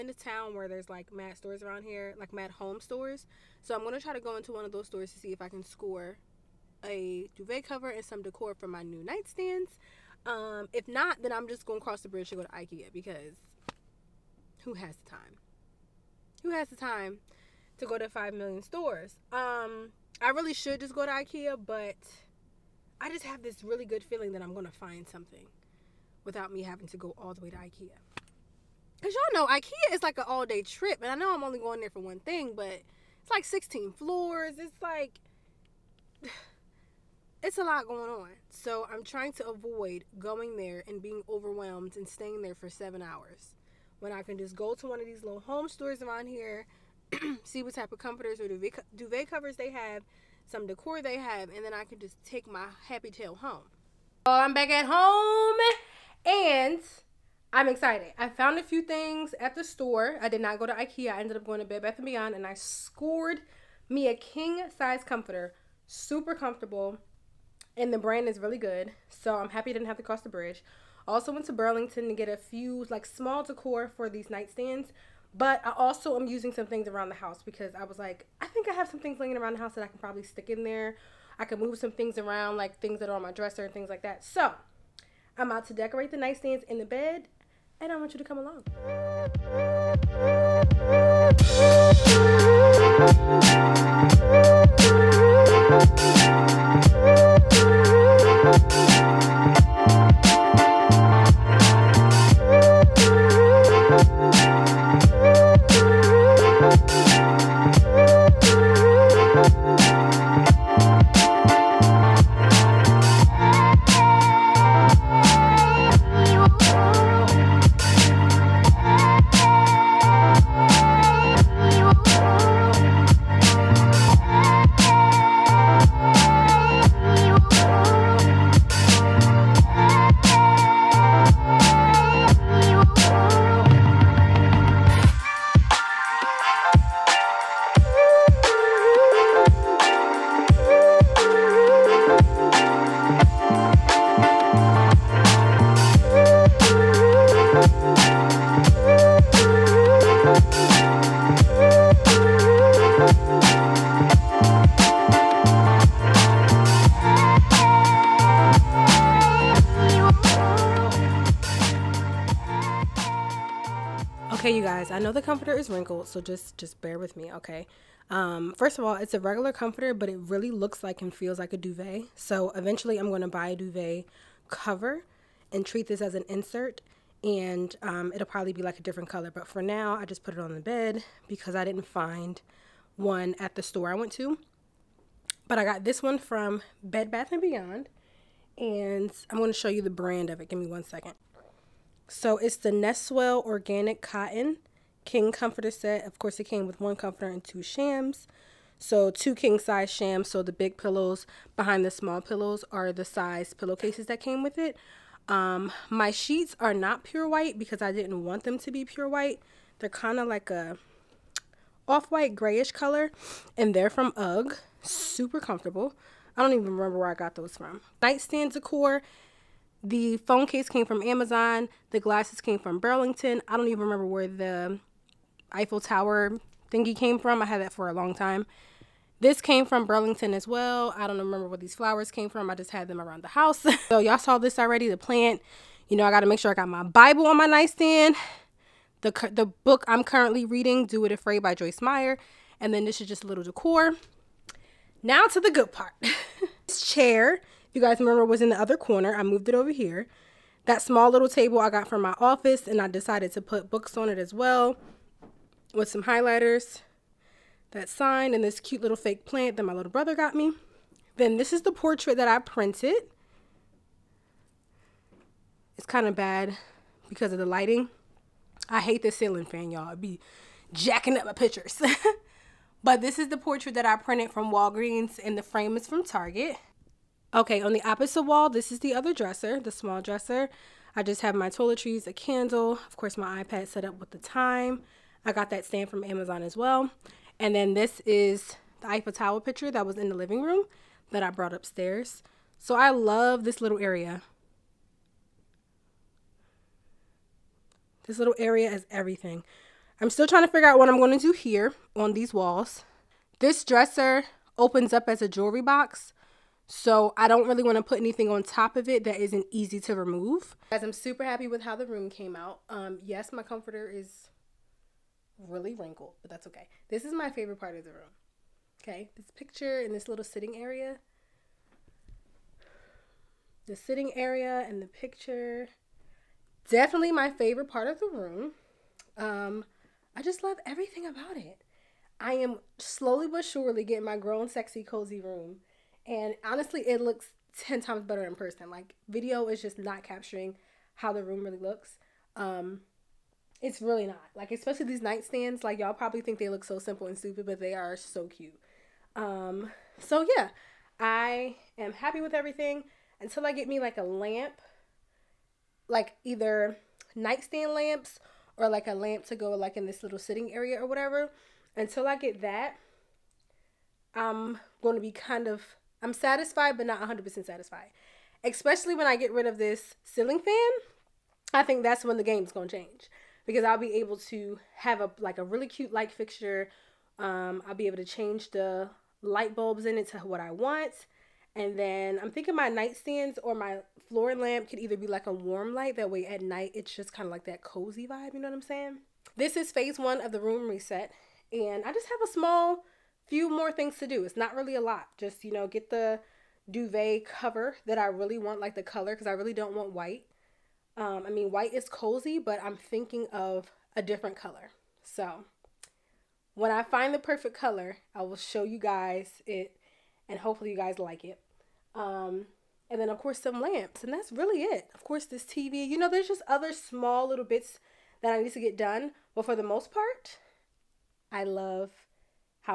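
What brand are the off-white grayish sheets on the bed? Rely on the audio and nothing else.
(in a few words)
UGG.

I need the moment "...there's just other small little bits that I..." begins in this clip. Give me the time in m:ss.
6:56.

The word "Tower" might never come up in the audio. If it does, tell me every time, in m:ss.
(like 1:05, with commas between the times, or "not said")
3:45, 4:49.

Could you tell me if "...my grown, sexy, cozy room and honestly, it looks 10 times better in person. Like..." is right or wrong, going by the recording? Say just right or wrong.
right.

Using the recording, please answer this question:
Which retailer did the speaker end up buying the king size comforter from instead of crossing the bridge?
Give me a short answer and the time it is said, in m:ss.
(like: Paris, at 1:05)
Bed Bath and Beyond, at 1:01.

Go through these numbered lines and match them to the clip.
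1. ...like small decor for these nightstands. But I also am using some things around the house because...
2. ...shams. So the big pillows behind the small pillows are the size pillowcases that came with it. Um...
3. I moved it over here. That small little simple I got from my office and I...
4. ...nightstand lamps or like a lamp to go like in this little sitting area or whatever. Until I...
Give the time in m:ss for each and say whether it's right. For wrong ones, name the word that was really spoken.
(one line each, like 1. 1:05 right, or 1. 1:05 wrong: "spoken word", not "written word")
1. 1:12 right
2. 3:19 right
3. 4:09 wrong: "table", not "simple"
4. 5:57 right.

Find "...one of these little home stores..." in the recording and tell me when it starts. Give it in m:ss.
0:44.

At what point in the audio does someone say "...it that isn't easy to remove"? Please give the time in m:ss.
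5:08.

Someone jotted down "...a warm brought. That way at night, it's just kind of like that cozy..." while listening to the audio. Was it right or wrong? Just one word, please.
wrong.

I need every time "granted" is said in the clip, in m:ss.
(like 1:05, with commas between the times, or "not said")
not said.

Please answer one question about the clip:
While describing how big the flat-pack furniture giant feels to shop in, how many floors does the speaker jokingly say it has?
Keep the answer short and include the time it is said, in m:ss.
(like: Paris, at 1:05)
16, at 0:33.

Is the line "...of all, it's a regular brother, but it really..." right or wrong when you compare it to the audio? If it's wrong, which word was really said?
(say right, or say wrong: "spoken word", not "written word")
wrong: "comforter", not "brother".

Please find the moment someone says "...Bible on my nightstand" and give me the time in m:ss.
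3:56.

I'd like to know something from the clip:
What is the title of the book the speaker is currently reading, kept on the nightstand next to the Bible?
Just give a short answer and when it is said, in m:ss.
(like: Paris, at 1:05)
Do It Afraid, at 4:00.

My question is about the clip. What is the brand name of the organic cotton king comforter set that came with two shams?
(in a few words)
Nestwell.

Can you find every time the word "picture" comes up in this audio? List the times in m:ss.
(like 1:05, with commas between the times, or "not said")
4:31, 4:49, 5:19, 5:24.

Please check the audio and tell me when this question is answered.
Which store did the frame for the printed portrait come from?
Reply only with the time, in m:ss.
4:36.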